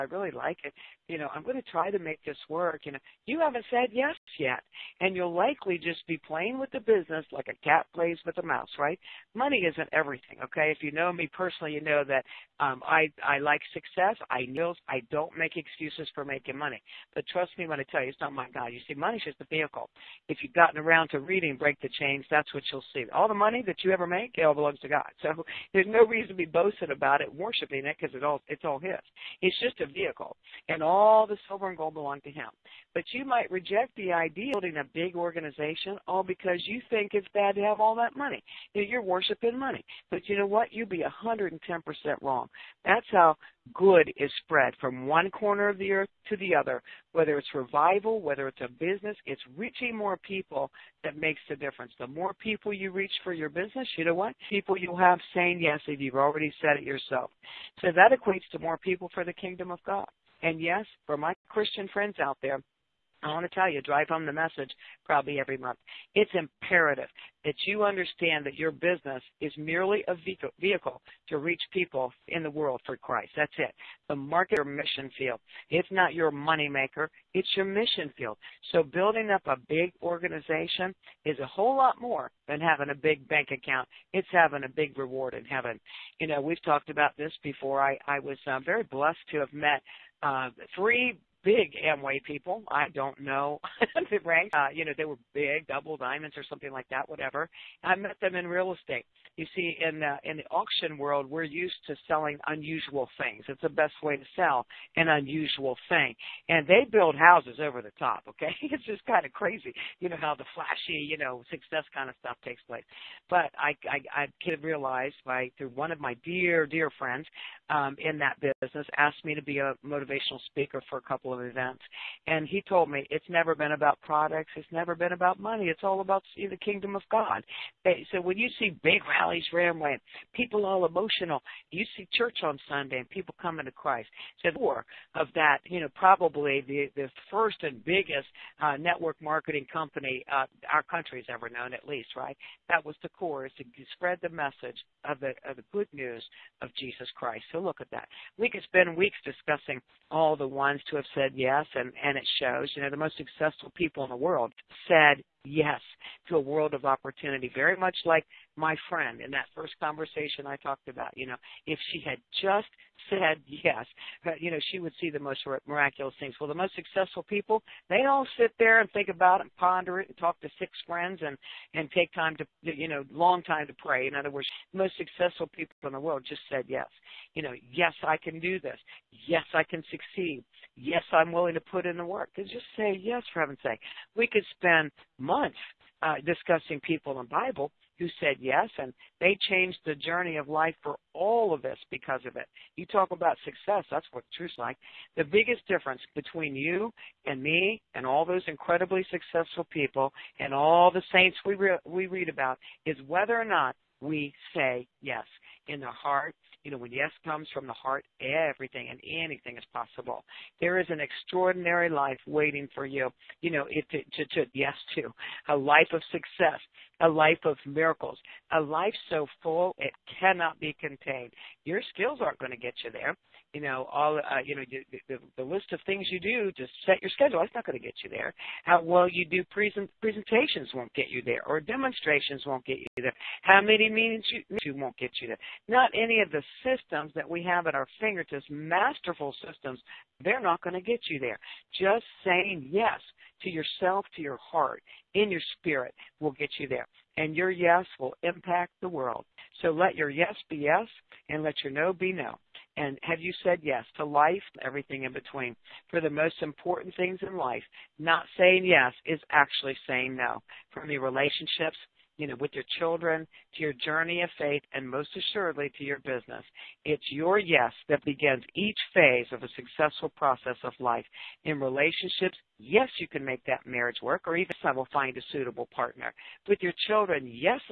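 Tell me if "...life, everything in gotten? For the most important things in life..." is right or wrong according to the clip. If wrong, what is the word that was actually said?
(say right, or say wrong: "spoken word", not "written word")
wrong: "between", not "gotten".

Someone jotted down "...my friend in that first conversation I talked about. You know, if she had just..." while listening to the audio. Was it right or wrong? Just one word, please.
right.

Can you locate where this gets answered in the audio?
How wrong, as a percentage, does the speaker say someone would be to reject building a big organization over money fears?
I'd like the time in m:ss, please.
0:41.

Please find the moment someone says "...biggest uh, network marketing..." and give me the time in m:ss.
2:17.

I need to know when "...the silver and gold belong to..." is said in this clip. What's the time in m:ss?
0:31.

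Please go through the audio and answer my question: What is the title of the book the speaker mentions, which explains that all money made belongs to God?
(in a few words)
Break the Chains.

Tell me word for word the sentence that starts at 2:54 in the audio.
In other words, the most successful people in the world just said yes.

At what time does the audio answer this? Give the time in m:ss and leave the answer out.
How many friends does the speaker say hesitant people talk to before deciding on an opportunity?
2:50.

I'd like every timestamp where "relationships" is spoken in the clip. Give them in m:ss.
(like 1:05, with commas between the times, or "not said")
4:20, 4:31.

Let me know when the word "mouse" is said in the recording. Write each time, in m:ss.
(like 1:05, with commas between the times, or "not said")
0:08.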